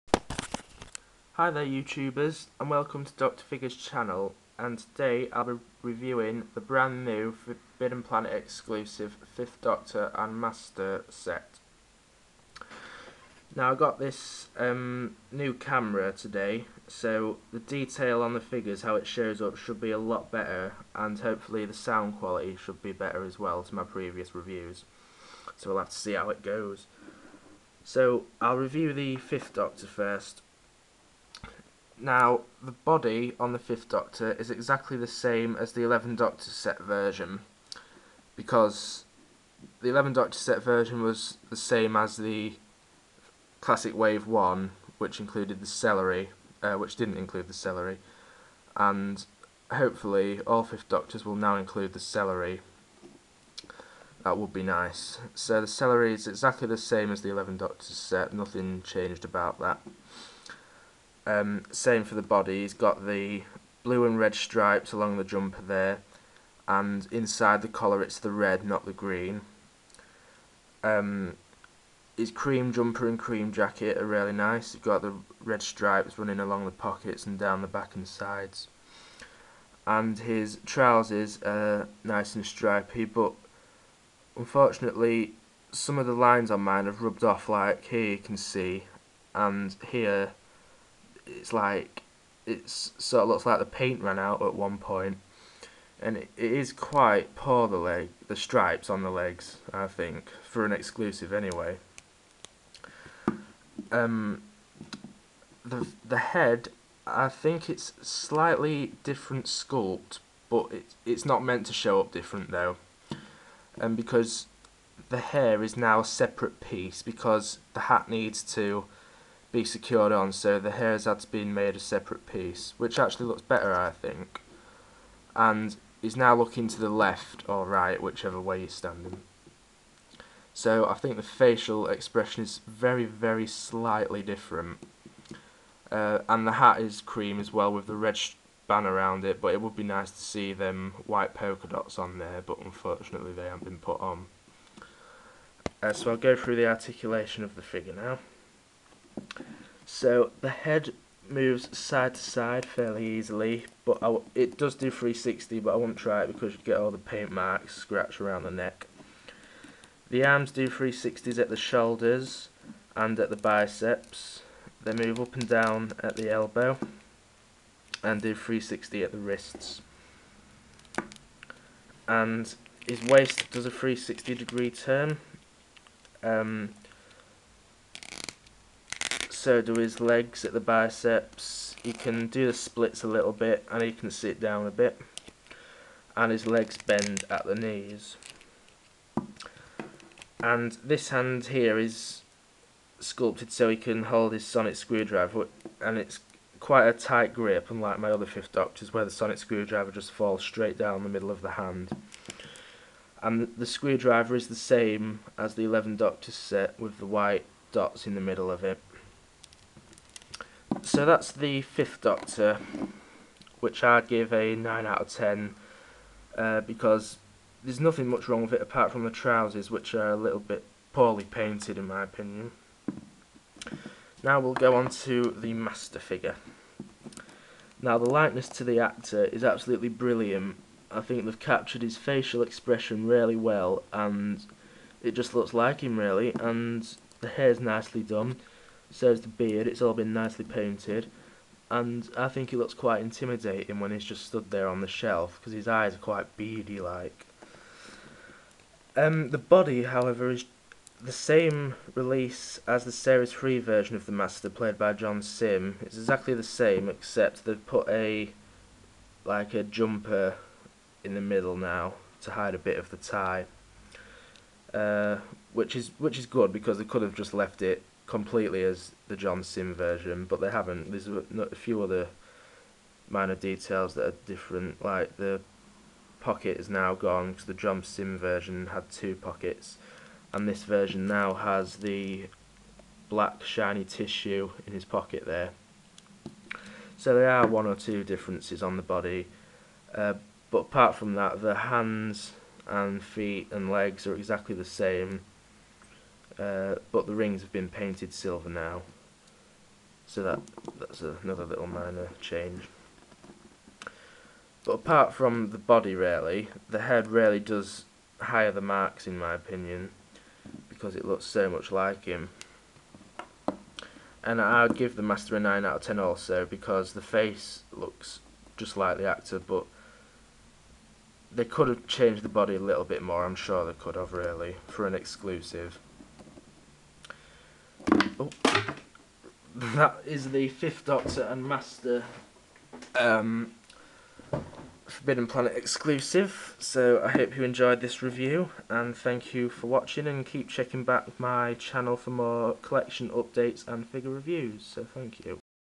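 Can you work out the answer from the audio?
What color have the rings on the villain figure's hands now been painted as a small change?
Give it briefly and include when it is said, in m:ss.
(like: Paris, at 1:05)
silver, at 4:58.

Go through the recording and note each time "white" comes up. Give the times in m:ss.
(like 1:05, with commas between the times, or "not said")
2:21, 3:27.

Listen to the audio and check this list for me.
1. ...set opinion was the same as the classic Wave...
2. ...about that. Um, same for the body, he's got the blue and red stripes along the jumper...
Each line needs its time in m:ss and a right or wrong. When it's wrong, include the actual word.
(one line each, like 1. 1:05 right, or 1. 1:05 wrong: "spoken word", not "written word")
1. 0:40 wrong: "version", not "opinion"
2. 0:59 right.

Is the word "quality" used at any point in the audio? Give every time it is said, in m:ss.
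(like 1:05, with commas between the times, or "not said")
0:22.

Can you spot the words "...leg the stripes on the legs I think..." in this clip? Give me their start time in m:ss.
1:37.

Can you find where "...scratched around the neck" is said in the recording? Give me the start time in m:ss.
2:37.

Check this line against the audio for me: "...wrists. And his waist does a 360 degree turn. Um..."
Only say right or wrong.
right.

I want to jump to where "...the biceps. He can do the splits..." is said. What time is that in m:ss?
3:00.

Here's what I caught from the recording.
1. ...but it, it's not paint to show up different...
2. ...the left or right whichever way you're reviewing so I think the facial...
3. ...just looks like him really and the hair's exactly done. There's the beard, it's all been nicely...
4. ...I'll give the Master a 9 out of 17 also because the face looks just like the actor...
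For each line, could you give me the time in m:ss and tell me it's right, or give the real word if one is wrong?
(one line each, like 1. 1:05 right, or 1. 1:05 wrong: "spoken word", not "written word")
1. 1:50 wrong: "meant", not "paint"
2. 2:06 wrong: "standing", not "reviewing"
3. 3:55 wrong: "nicely", not "exactly"
4. 5:14 wrong: "10", not "17".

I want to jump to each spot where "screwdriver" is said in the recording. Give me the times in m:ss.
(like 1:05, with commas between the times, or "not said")
3:14, 3:19, 3:23.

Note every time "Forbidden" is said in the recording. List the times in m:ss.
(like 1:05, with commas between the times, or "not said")
0:07, 5:34.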